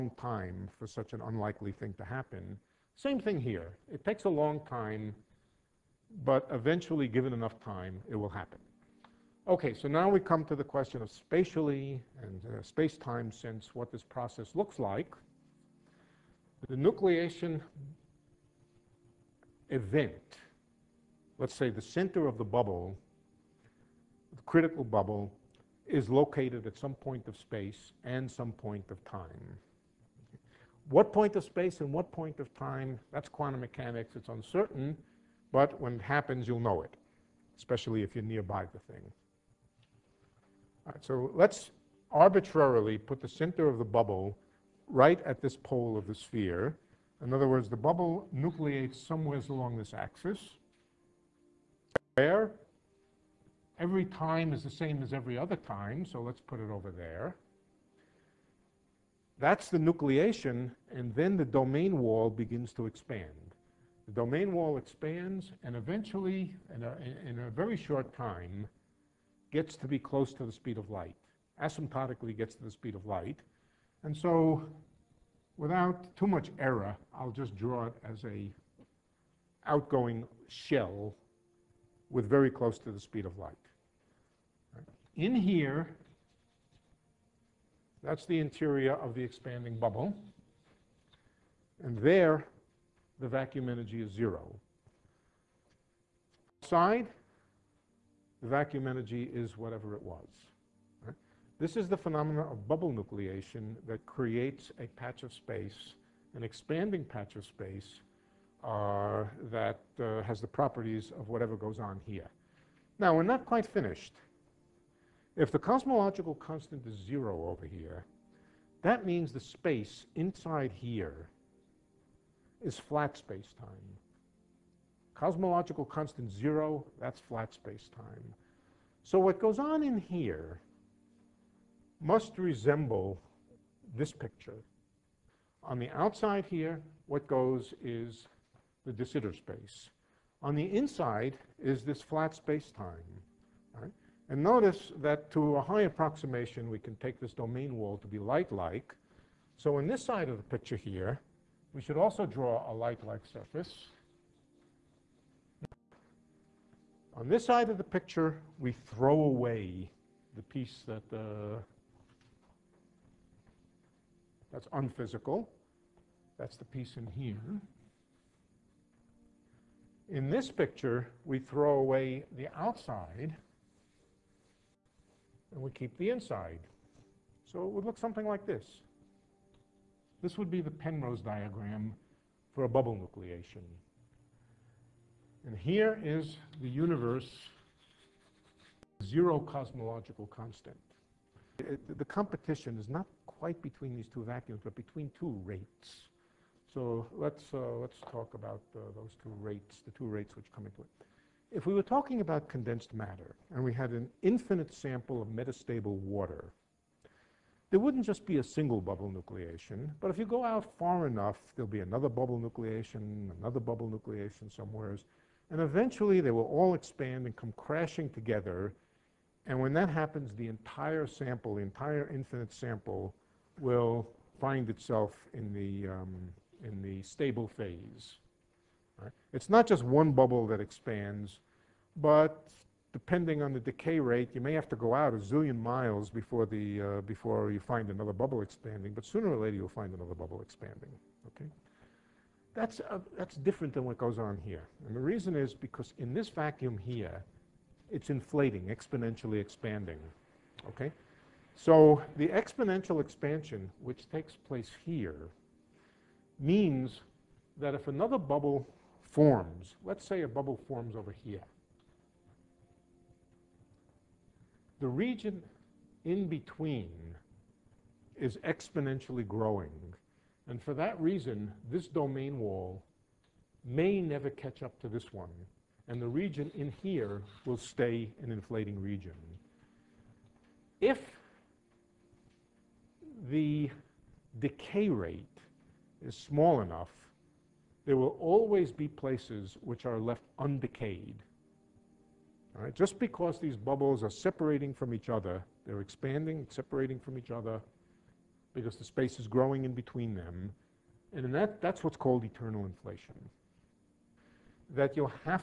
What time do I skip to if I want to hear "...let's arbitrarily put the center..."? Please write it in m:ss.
0:41.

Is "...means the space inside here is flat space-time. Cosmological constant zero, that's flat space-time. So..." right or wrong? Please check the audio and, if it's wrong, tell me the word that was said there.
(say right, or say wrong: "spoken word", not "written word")
right.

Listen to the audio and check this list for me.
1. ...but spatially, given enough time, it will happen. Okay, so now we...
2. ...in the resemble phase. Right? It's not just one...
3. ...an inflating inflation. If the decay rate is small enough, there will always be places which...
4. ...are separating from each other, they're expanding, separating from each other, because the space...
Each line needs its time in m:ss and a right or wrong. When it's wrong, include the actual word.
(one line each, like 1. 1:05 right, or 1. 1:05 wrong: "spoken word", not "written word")
1. 0:06 wrong: "eventually", not "spatially"
2. 3:46 wrong: "stable", not "resemble"
3. 4:38 wrong: "region", not "inflation"
4. 4:54 right.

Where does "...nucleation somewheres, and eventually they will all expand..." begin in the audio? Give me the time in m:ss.
3:33.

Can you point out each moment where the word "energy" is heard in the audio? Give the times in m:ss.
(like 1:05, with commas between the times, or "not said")
1:33, 1:38.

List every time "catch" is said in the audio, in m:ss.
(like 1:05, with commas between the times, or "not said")
4:34.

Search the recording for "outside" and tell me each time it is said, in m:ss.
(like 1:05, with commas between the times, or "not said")
1:36, 2:15, 2:52.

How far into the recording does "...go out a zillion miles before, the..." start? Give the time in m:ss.
3:54.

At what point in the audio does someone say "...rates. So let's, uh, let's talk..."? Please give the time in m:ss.
3:15.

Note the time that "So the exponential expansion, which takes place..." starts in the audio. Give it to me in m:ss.
4:11.